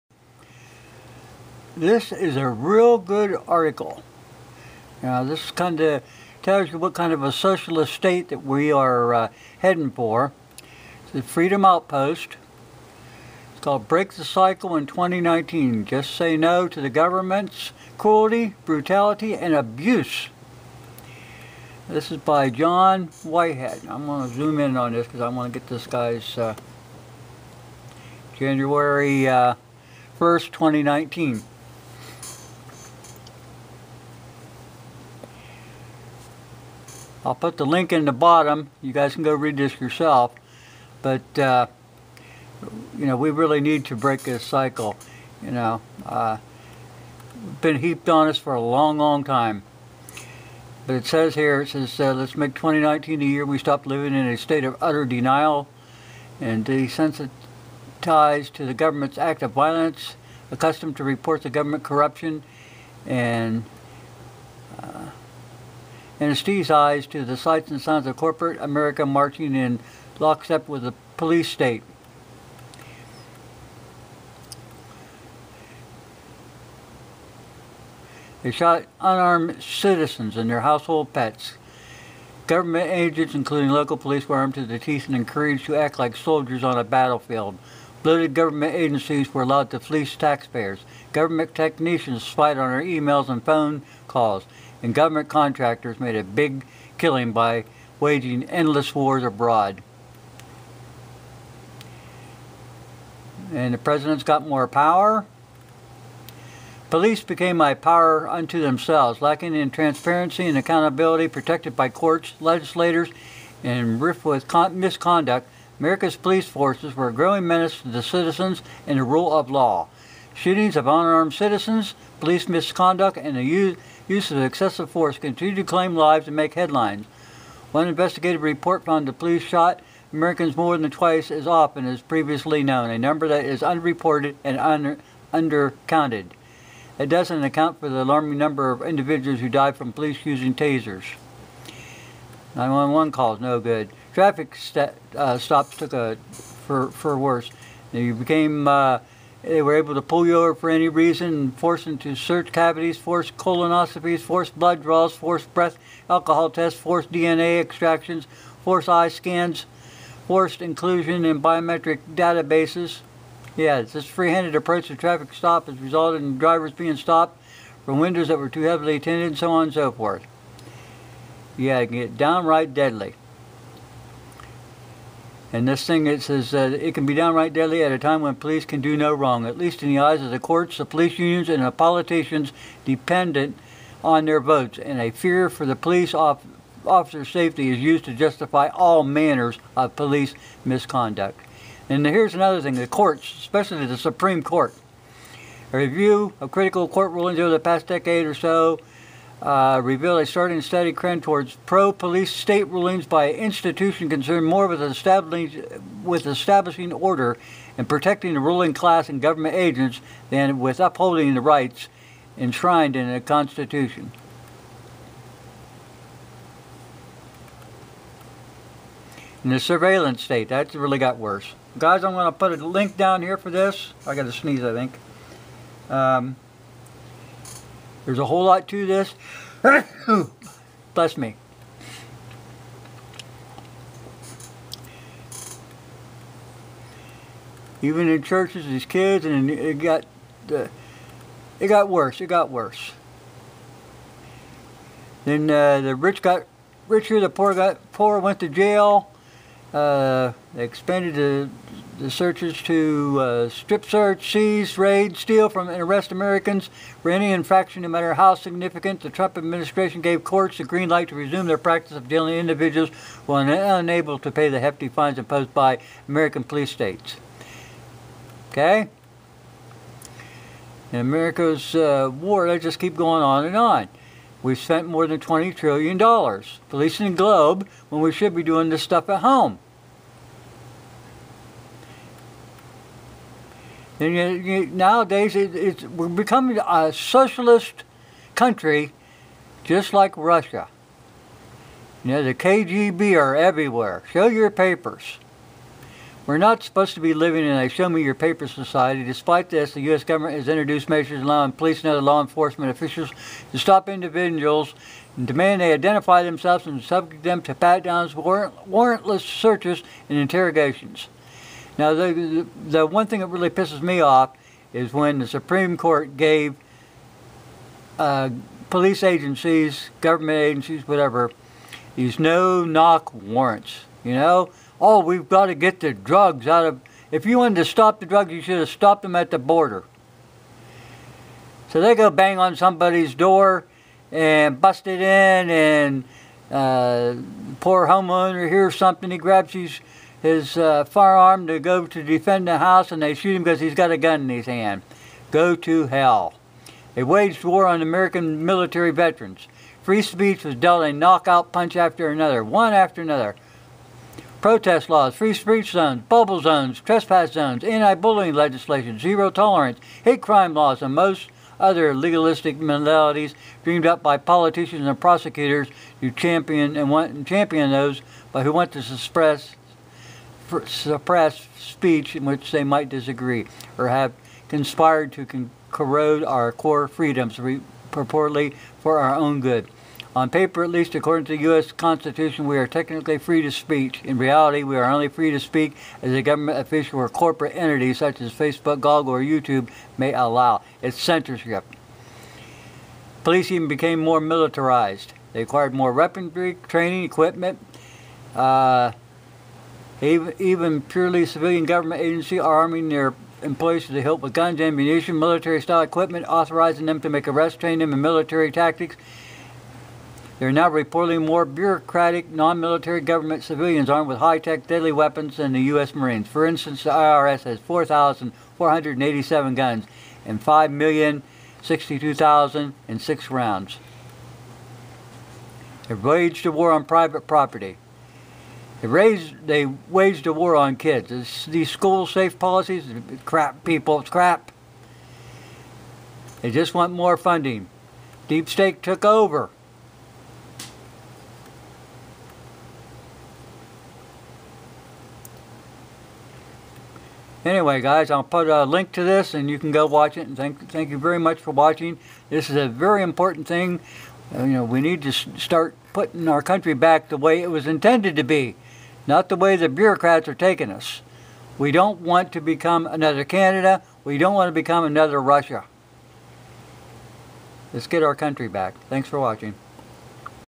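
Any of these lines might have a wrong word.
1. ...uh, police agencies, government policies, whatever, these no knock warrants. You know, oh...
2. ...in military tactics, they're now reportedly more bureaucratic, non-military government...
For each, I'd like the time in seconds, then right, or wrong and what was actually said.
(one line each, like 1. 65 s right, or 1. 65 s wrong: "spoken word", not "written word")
1. 317 s wrong: "agencies", not "policies"
2. 407 s right.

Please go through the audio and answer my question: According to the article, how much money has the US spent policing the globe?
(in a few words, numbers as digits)
$20 trillion.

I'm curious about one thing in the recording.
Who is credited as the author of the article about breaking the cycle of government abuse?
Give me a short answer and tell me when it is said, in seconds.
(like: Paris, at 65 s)
John Whitehead, at 22 s.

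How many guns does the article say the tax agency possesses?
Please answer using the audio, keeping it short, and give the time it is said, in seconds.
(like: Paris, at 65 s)
4,487, at 417 s.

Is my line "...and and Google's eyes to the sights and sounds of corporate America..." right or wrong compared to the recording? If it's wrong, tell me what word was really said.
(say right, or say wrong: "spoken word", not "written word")
wrong: "Steve", not "Google".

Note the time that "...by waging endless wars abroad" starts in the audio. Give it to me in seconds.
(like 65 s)
97 s.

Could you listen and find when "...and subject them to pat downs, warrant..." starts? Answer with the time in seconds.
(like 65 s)
306 s.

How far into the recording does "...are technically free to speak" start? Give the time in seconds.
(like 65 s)
382 s.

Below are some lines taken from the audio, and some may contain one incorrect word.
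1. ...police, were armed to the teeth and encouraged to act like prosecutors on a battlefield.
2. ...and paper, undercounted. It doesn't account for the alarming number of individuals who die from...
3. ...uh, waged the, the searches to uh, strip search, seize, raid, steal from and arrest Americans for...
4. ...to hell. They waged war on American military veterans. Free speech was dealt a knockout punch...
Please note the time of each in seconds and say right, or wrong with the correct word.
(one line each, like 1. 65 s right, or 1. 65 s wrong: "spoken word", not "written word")
1. 83 s wrong: "soldiers", not "prosecutors"
2. 134 s wrong: "under", not "paper"
3. 249 s wrong: "expanded", not "waged"
4. 345 s right.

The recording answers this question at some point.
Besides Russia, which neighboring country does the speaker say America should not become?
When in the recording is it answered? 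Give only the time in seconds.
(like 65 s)
463 s.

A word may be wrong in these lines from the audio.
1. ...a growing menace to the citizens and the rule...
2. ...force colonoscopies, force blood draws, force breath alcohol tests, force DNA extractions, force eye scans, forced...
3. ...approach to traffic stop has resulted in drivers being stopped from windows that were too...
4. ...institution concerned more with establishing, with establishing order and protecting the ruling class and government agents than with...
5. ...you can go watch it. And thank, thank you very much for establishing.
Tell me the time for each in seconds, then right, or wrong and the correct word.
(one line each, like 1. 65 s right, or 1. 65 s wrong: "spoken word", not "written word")
1. 117 s right
2. 152 s right
3. 164 s right
4. 203 s right
5. 449 s wrong: "watching", not "establishing".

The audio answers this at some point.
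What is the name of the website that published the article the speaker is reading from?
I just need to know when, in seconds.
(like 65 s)
11 s.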